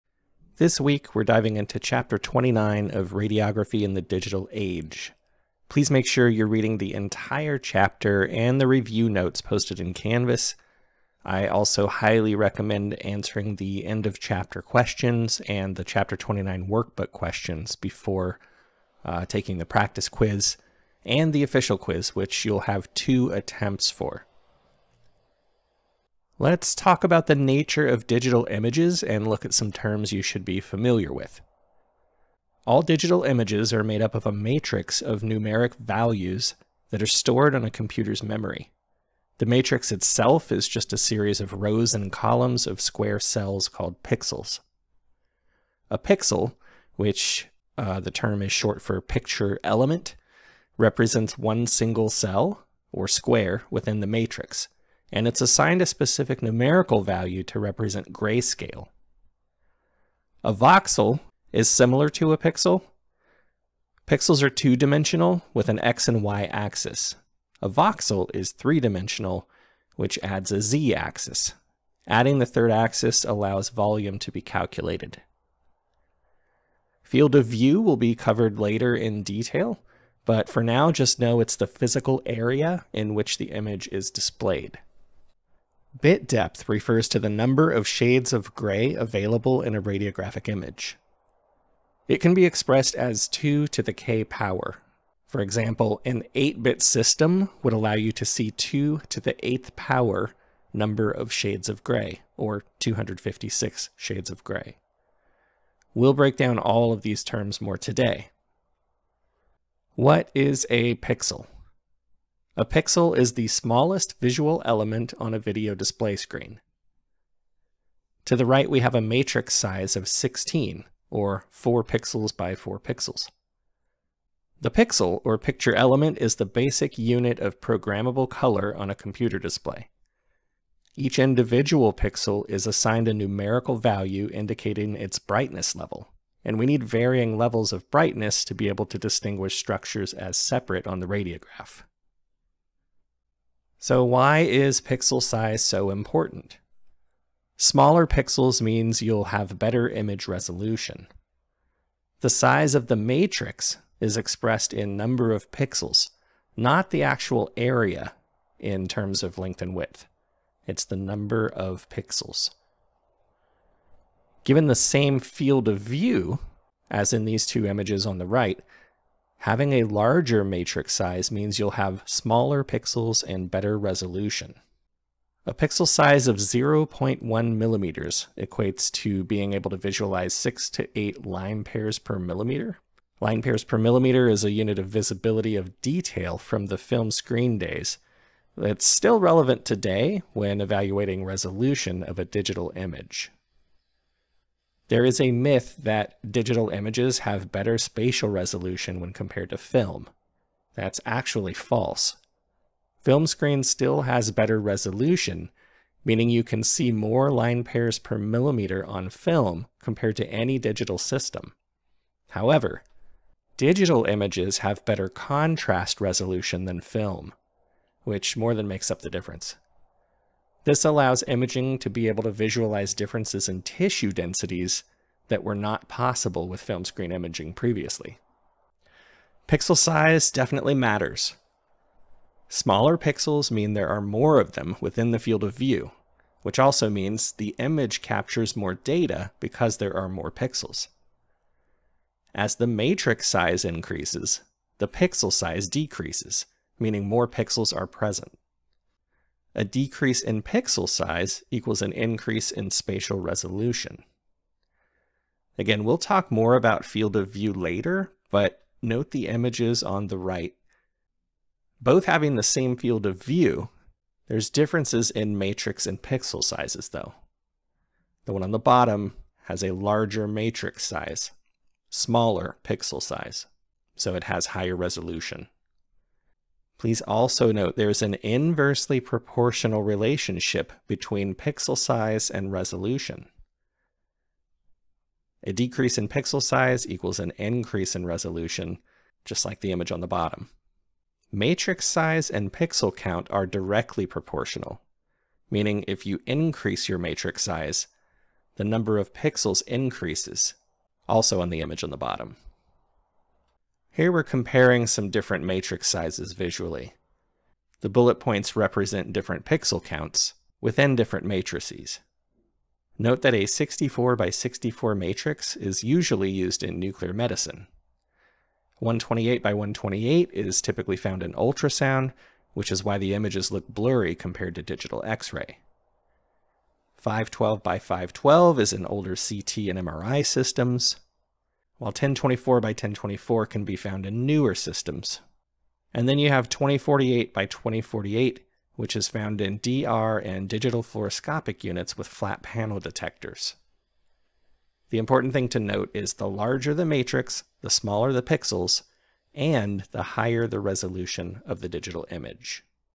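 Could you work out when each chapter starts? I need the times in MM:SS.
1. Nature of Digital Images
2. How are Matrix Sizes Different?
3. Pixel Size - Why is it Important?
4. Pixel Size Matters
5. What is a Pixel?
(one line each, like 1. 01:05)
1. 00:25
2. 05:03
3. 02:23
4. 03:48
5. 01:49.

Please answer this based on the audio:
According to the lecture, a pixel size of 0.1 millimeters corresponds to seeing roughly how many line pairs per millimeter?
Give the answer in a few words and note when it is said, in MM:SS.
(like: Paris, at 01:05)
6 to 8, at 03:00.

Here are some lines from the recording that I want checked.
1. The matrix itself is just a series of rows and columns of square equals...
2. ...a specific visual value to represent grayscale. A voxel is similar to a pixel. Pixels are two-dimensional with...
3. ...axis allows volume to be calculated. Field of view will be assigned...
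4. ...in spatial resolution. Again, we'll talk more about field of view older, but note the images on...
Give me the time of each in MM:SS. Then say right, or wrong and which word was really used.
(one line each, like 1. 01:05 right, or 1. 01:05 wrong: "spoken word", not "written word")
1. 00:39 wrong: "cells", not "equals"
2. 00:55 wrong: "numerical", not "visual"
3. 01:12 wrong: "covered", not "assigned"
4. 04:12 wrong: "later", not "older".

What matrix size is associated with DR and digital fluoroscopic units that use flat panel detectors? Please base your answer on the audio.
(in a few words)
2048 by 2048.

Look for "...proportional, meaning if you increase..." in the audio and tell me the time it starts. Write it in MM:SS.
04:54.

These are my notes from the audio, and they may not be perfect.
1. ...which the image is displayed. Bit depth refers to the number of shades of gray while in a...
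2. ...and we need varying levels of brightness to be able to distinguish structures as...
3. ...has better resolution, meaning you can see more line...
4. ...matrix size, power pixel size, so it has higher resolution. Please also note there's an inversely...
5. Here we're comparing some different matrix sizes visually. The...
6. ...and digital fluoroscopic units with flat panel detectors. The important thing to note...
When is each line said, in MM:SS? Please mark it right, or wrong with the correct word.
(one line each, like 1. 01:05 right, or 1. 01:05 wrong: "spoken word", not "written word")
1. 01:23 wrong: "available", not "while"
2. 02:16 right
3. 03:24 right
4. 04:30 wrong: "smaller", not "power"
5. 05:03 right
6. 05:40 right.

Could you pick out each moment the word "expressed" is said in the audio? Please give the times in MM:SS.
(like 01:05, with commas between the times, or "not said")
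01:32, 02:34.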